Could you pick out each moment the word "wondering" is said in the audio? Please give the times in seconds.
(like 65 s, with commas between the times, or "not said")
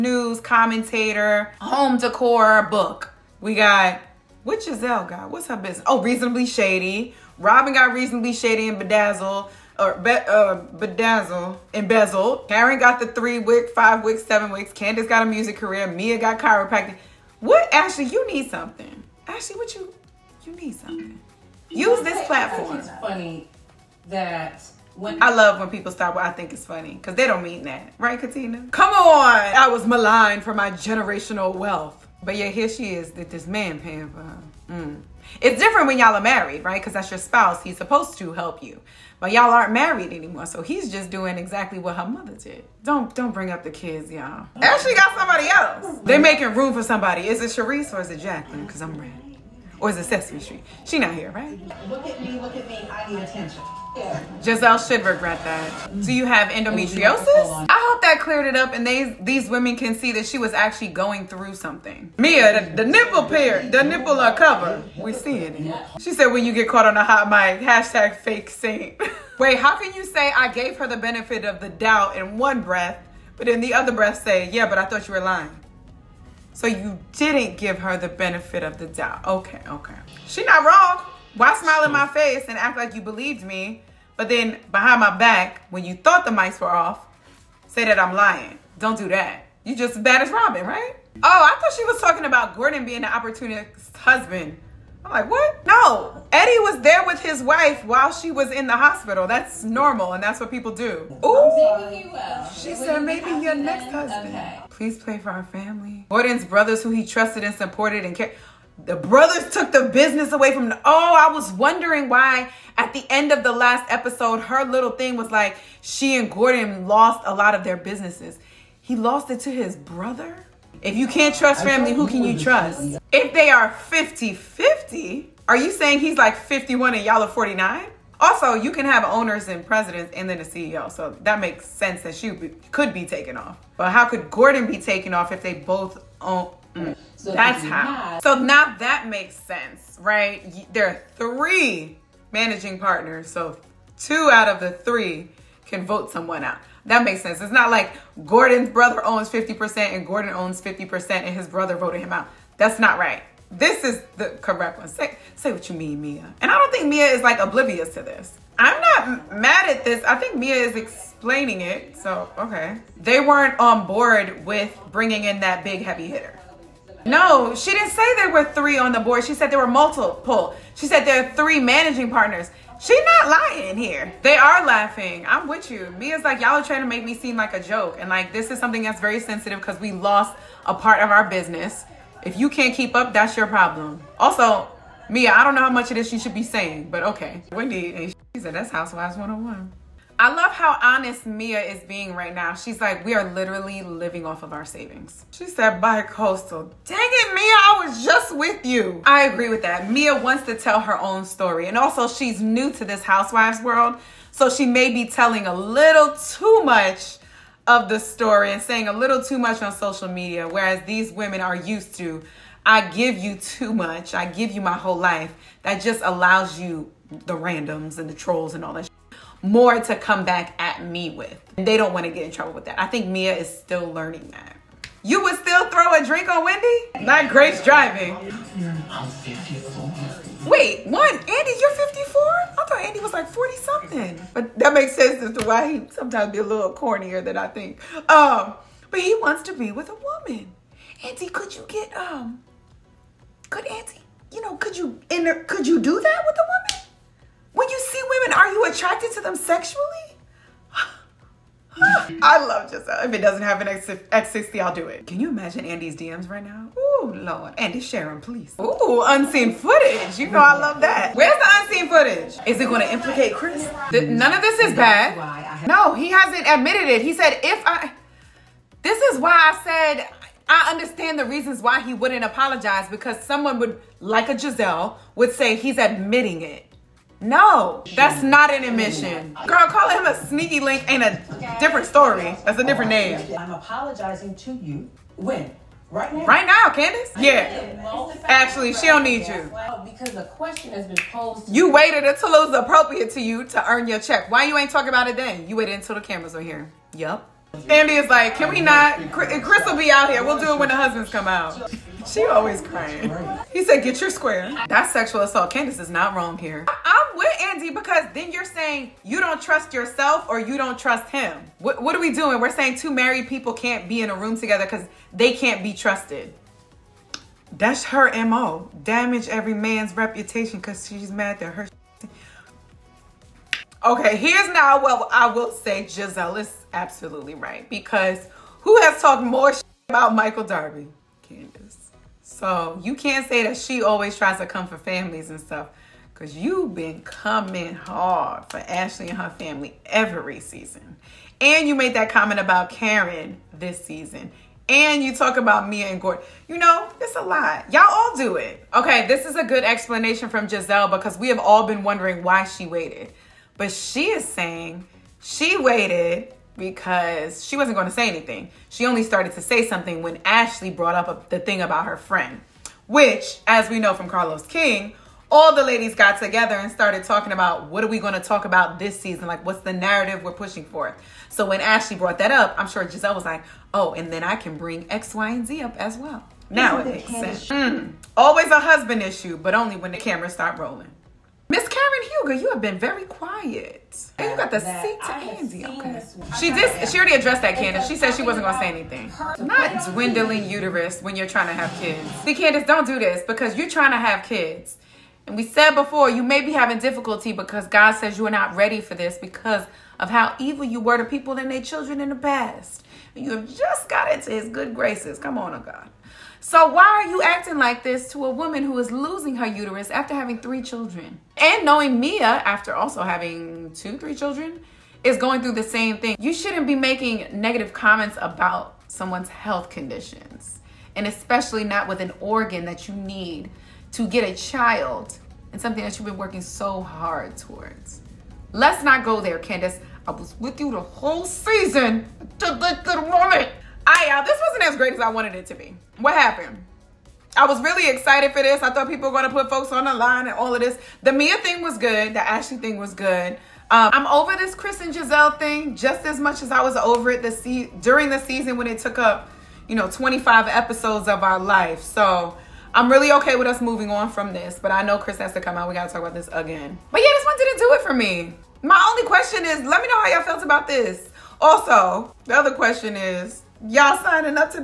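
111 s, 351 s.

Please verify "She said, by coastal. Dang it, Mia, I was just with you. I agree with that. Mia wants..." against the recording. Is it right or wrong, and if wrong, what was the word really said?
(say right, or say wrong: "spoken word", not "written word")
right.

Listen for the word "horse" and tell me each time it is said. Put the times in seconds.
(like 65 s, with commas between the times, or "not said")
not said.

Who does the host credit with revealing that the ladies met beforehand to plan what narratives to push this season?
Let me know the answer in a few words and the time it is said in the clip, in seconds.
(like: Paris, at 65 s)
Carlos King, at 364 s.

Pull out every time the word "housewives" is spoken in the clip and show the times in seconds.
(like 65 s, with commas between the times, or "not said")
188 s, 203 s.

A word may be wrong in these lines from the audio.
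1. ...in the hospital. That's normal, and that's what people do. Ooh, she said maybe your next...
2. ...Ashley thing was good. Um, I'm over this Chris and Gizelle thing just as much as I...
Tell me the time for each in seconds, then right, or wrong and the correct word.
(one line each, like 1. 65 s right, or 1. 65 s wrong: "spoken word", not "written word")
1. 98 s right
2. 442 s right.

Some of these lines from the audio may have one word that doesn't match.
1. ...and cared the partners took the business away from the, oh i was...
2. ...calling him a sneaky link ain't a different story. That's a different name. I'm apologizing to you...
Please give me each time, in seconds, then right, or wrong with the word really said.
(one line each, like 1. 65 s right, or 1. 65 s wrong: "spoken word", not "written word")
1. 108 s wrong: "brothers", not "partners"
2. 279 s right.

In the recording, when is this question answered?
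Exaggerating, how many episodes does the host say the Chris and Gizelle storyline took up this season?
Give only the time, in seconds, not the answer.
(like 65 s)
449 s.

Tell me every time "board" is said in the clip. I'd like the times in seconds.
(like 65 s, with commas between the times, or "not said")
163 s, 168 s.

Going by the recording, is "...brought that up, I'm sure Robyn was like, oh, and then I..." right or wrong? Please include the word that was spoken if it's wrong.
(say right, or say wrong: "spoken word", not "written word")
wrong: "Gizelle", not "Robyn".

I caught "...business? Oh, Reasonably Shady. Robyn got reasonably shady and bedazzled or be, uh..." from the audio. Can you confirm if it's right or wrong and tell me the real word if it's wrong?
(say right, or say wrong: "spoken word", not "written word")
right.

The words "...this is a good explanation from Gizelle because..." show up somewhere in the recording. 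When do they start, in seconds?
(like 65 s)
349 s.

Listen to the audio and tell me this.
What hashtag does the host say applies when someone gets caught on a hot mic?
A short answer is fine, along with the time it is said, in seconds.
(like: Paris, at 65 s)
Fake saint, at 68 s.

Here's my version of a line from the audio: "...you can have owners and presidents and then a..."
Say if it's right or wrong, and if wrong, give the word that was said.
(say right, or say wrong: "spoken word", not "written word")
right.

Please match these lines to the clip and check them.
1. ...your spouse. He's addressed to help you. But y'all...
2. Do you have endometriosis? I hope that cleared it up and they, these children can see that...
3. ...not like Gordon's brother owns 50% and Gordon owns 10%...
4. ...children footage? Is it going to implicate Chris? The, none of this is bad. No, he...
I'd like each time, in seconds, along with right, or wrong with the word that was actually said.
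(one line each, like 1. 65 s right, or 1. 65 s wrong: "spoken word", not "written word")
1. 37 s wrong: "supposed", not "addressed"
2. 56 s wrong: "women", not "children"
3. 147 s wrong: "50", not "10"
4. 261 s wrong: "unseen", not "children".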